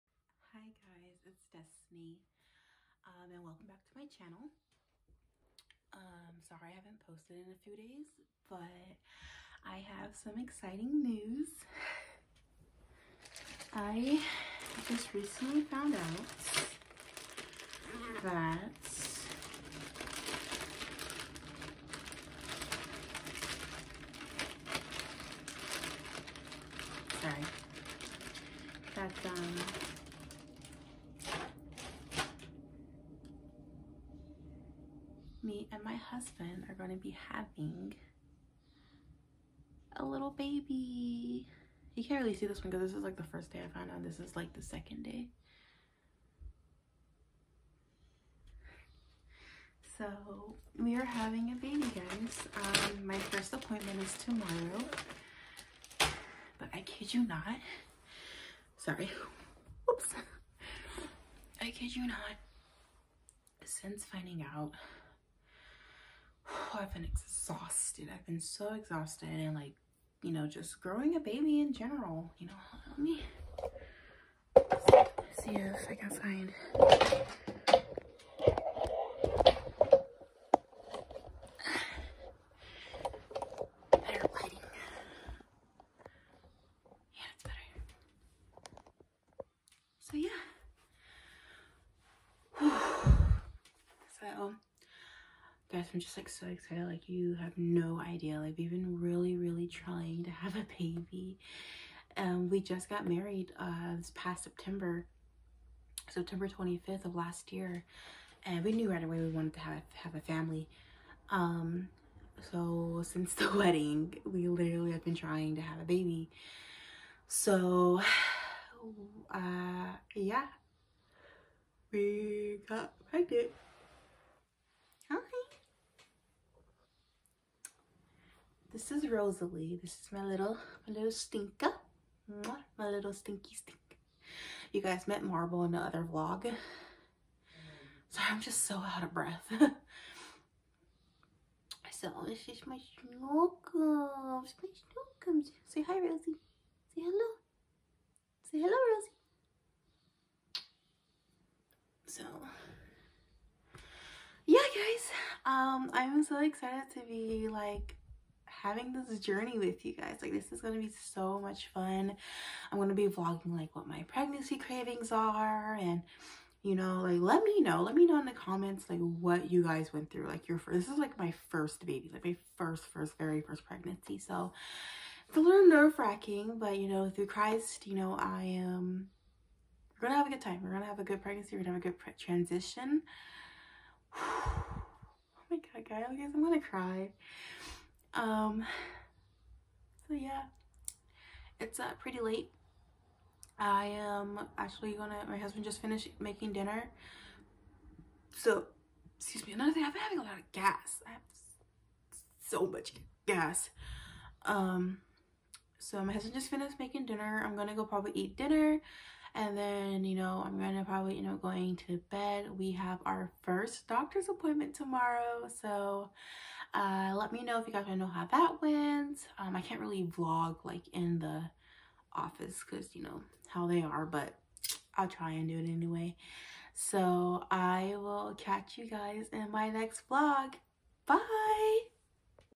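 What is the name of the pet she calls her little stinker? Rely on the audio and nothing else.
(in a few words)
Rosalie.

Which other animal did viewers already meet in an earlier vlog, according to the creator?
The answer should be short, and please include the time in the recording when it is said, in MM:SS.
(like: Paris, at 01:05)
Marble, at 02:15.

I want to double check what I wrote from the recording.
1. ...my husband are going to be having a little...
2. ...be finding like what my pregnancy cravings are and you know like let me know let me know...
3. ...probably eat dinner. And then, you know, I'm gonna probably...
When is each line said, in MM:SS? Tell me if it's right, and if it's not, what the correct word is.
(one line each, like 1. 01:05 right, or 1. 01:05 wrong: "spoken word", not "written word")
1. 00:35 right
2. 02:42 wrong: "vlogging", not "finding"
3. 03:27 right.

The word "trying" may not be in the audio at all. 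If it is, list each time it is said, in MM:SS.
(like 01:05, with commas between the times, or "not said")
01:39, 01:55.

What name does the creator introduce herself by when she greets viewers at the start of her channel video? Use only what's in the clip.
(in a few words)
Destiny.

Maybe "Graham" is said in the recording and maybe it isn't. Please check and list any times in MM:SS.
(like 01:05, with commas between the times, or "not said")
not said.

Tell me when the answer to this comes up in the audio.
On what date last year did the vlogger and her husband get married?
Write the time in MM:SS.
01:46.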